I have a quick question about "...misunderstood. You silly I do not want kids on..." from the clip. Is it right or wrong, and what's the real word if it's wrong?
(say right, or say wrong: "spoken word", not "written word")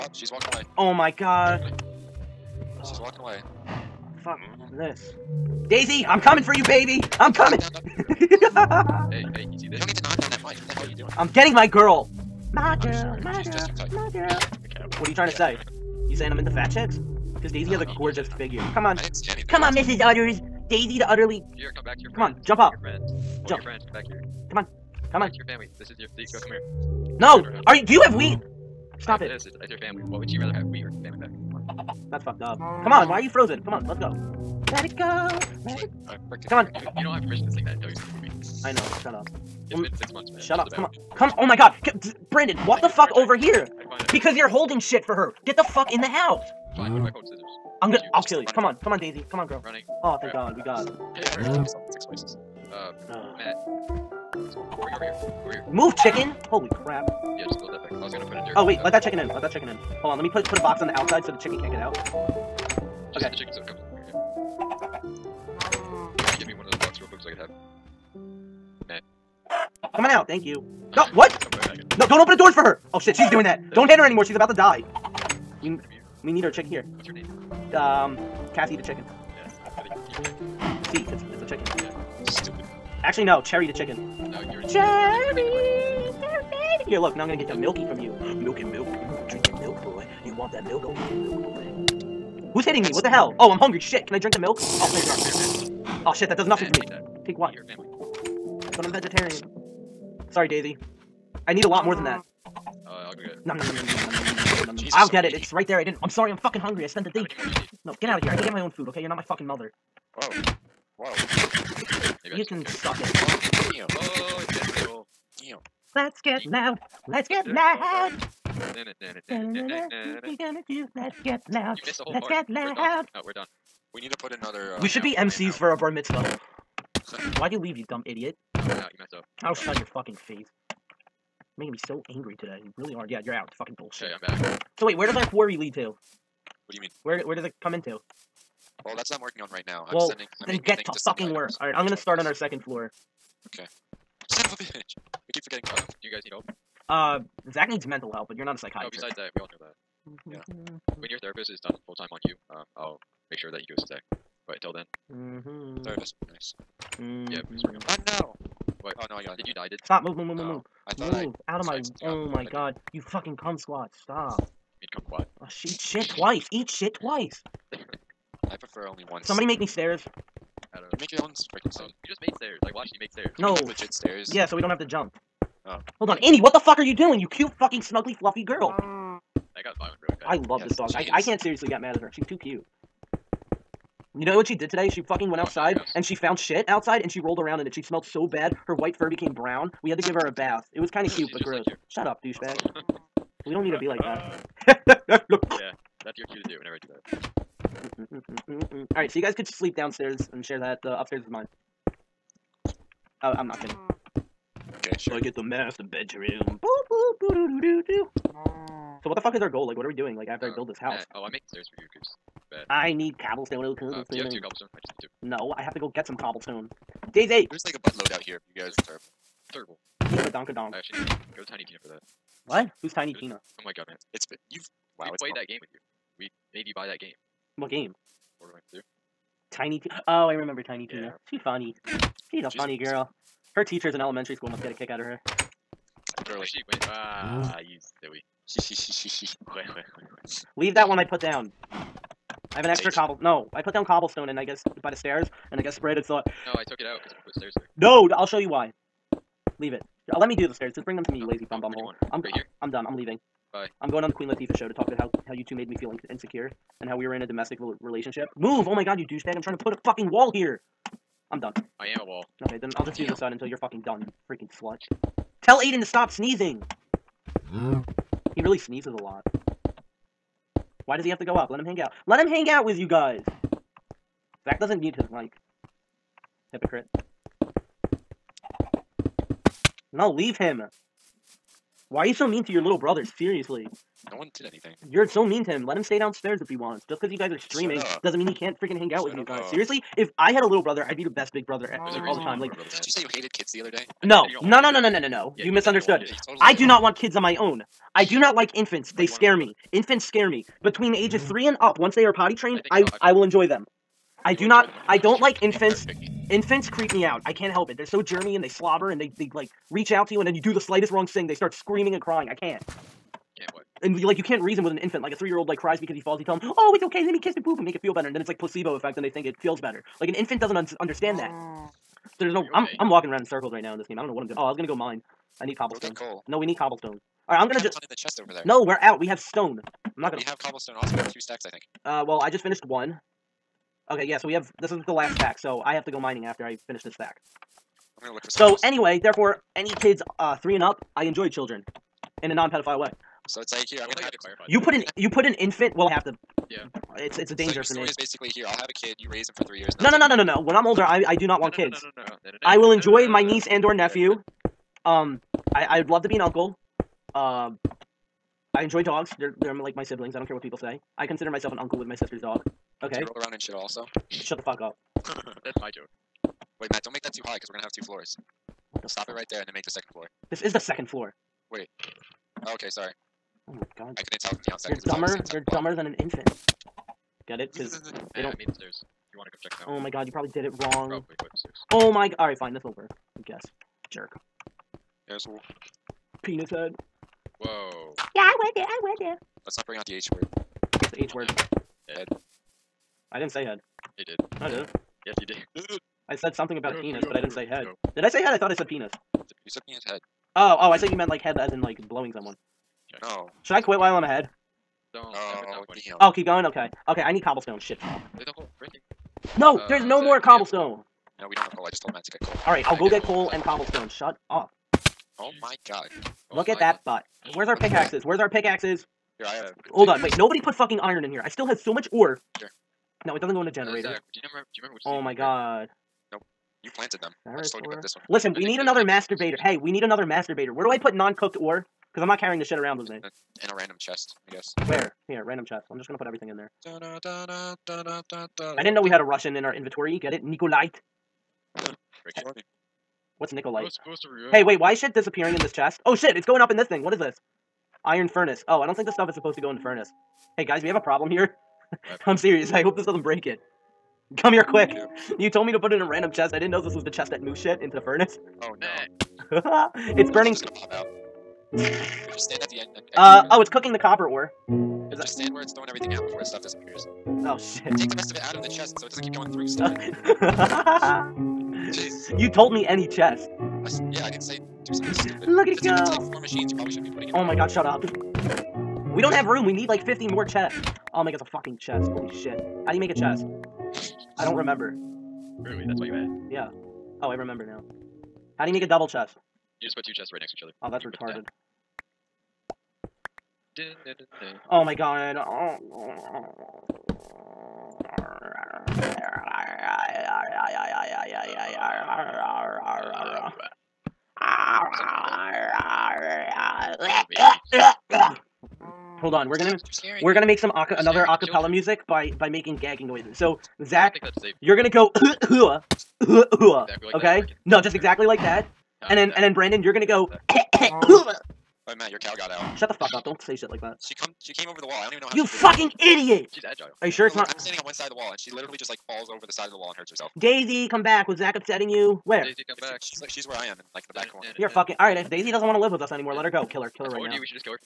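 wrong: "totally", not "silly".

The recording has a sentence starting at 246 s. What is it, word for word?
No, I took it out because I put stairs there.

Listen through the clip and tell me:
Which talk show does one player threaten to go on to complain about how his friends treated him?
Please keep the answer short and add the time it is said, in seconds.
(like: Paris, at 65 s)
The Queen Latifah show, at 254 s.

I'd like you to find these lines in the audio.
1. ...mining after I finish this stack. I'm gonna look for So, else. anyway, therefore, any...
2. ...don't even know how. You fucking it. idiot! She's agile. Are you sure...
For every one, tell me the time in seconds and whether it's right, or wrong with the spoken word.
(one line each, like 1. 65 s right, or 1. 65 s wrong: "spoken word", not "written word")
1. 335 s right
2. 524 s right.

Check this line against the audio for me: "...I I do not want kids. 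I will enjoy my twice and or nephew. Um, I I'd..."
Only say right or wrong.
wrong.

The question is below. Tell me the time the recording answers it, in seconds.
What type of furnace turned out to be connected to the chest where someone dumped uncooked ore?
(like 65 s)
447 s.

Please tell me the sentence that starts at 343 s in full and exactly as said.
So it's like here I'm gonna have to clarify.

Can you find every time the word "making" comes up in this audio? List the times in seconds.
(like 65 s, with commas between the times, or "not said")
131 s, 211 s, 512 s.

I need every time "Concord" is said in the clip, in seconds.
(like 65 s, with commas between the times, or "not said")
not said.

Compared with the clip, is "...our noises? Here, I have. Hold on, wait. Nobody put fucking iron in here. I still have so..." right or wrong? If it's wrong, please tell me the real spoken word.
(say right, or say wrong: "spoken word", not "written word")
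wrong: "pickaxes", not "noises".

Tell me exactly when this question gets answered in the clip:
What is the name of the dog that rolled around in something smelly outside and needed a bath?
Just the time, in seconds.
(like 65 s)
176 s.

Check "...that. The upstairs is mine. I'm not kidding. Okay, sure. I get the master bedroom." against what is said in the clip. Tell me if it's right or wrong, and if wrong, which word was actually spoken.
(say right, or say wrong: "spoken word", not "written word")
right.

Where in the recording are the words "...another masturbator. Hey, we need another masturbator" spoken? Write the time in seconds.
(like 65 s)
428 s.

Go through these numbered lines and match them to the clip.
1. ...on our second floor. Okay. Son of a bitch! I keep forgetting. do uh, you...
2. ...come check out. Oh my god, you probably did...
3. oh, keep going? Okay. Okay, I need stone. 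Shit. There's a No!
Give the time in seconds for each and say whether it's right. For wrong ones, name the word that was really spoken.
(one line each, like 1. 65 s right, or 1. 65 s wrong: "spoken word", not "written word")
1. 142 s right
2. 379 s right
3. 406 s wrong: "cobblestone", not "stone".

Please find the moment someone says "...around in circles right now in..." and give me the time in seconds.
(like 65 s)
323 s.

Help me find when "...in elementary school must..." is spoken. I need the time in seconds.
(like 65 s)
233 s.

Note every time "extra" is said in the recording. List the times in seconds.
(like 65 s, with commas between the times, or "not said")
242 s.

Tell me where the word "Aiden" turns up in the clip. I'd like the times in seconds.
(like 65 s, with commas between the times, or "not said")
265 s.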